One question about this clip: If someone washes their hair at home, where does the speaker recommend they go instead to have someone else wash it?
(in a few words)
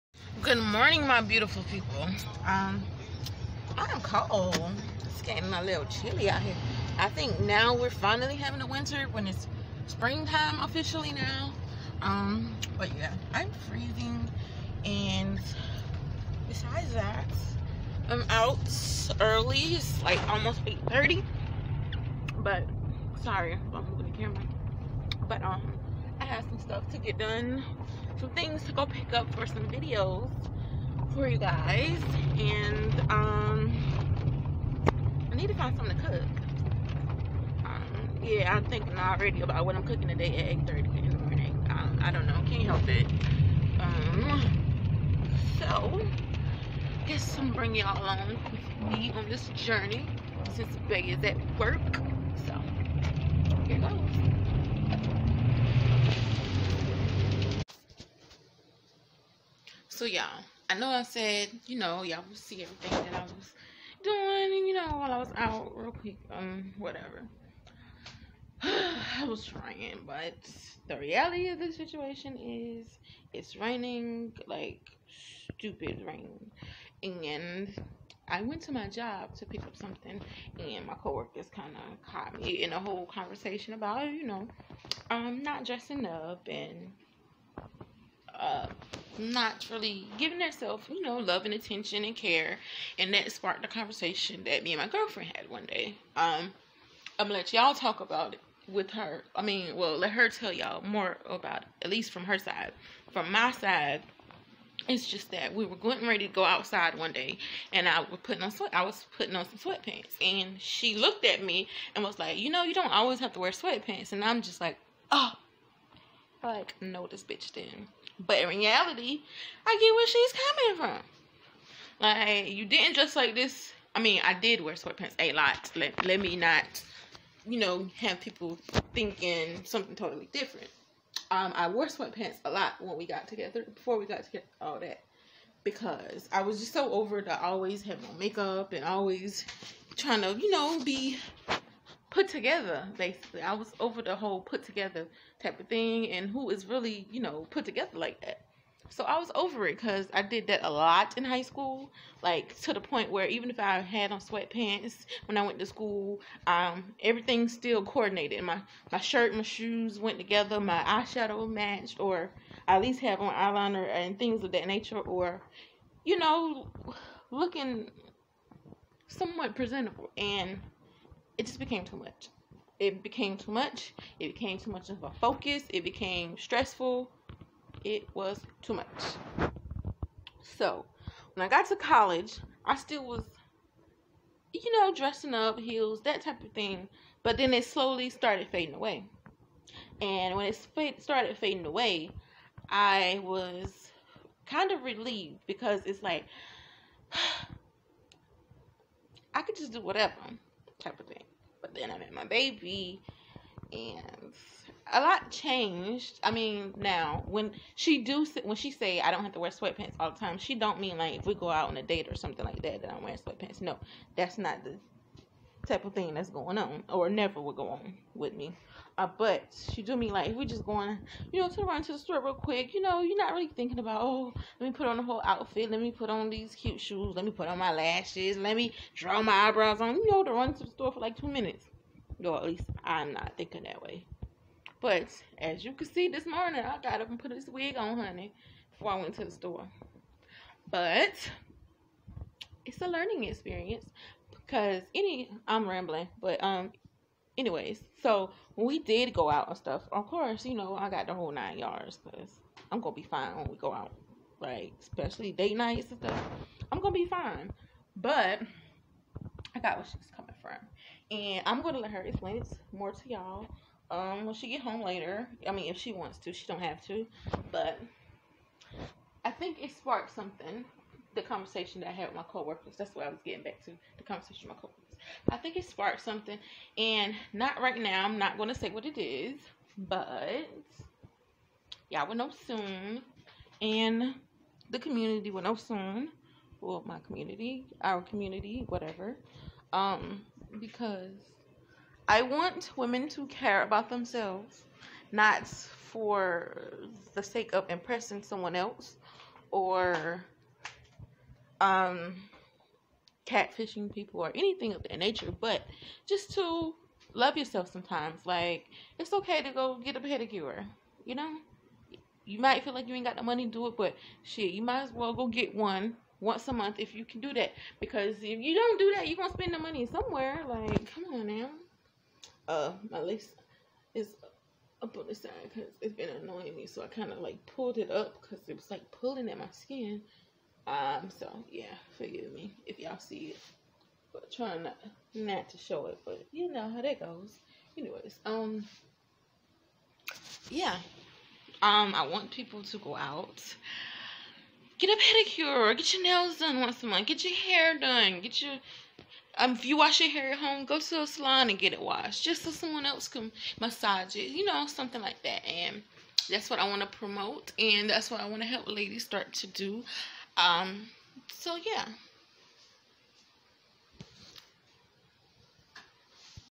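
A salon.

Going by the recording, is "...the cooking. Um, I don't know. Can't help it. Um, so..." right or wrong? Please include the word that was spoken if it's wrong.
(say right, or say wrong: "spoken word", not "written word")
wrong: "morning", not "cooking".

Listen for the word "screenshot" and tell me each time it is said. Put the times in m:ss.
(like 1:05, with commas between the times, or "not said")
not said.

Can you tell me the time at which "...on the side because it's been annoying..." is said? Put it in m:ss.
5:24.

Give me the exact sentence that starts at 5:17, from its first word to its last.
Because if you don't do that, you're going to spend the money somewhere.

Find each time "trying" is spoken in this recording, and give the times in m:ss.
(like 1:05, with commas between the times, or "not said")
1:09, 2:19, 5:34.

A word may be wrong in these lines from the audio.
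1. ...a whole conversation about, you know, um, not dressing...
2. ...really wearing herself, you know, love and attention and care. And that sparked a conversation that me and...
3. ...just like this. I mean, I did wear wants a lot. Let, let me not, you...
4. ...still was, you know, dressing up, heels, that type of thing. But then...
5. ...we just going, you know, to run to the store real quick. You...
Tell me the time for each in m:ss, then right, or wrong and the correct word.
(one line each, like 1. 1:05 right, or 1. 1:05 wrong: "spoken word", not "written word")
1. 1:22 right
2. 1:29 wrong: "giving", not "wearing"
3. 2:02 wrong: "sweatpants", not "wants"
4. 3:02 right
5. 3:40 right.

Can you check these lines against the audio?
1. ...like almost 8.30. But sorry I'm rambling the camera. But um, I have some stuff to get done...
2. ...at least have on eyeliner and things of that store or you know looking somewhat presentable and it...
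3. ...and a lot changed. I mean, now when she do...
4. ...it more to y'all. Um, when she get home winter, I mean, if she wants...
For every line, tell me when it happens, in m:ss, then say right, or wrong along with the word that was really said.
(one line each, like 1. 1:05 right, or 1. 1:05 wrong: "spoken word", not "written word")
1. 0:20 wrong: "moving", not "rambling"
2. 2:42 wrong: "nature", not "store"
3. 3:23 right
4. 4:22 wrong: "later", not "winter".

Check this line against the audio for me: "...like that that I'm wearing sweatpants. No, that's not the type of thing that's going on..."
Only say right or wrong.
right.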